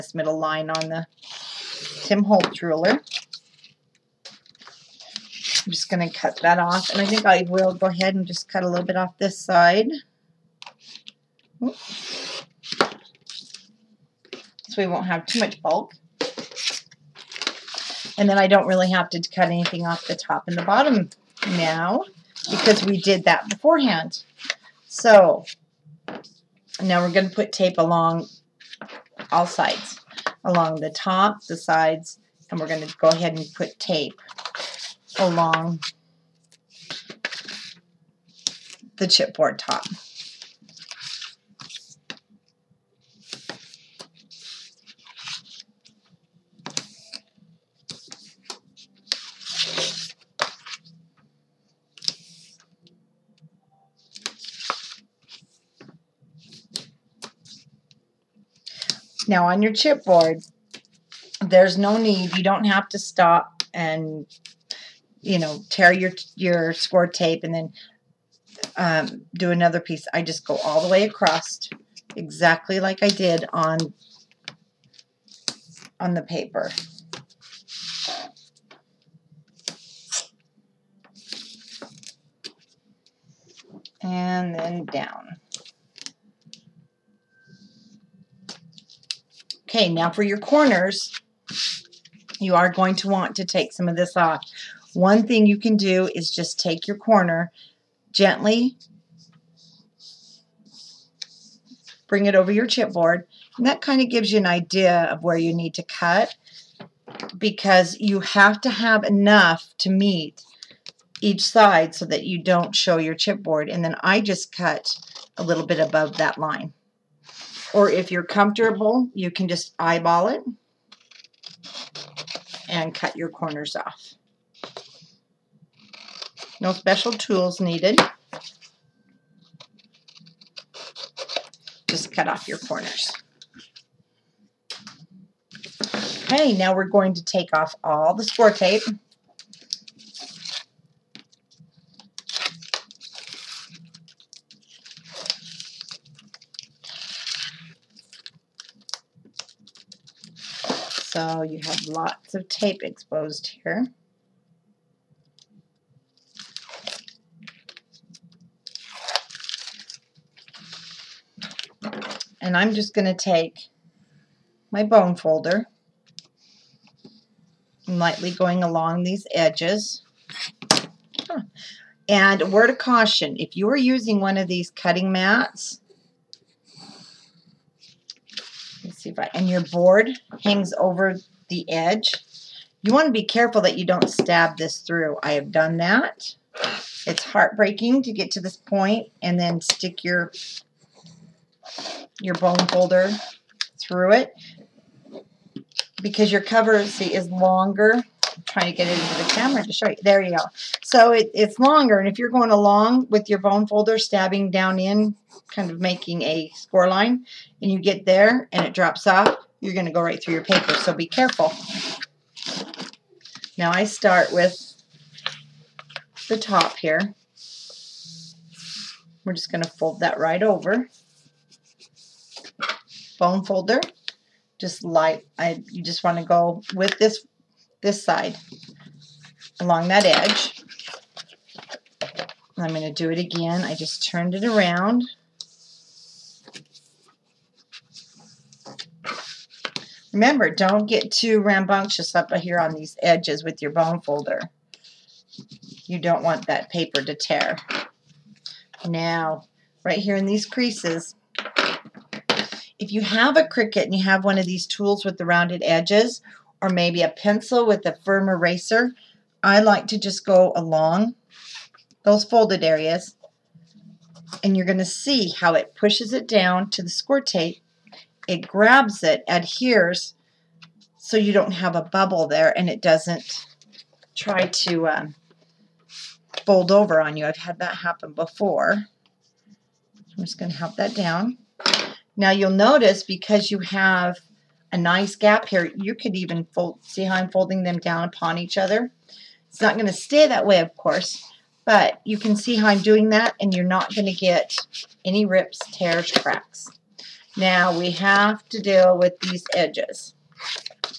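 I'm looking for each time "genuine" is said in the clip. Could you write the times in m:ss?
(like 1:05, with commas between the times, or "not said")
not said.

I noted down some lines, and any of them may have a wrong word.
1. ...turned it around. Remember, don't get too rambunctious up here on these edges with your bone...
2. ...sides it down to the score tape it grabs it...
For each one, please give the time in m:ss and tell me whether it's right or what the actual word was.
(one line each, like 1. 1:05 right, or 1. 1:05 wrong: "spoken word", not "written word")
1. 3:54 right
2. 4:25 wrong: "pushes", not "sides".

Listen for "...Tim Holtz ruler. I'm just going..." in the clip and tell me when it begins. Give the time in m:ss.
0:02.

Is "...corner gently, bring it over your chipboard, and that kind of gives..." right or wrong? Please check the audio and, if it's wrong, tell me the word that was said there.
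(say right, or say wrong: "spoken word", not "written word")
right.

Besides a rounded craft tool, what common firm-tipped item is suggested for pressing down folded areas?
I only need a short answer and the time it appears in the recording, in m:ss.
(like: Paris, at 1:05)
pencil with a firm eraser, at 4:17.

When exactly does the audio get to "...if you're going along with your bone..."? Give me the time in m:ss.
3:22.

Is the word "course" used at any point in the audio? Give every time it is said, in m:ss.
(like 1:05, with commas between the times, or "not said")
4:50.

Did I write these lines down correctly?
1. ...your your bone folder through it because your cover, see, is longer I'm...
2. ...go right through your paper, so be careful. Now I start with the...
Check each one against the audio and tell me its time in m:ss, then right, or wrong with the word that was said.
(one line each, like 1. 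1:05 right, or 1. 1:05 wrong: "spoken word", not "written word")
1. 3:10 right
2. 3:29 right.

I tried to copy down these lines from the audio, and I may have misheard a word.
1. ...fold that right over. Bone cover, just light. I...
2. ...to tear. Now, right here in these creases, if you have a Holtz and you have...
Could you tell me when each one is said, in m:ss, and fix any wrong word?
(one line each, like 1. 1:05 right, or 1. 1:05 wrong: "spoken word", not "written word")
1. 3:39 wrong: "folder", not "cover"
2. 4:07 wrong: "Cricut", not "Holtz".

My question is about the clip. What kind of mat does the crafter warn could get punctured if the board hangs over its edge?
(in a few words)
cutting mats.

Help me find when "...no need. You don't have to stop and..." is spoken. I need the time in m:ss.
1:01.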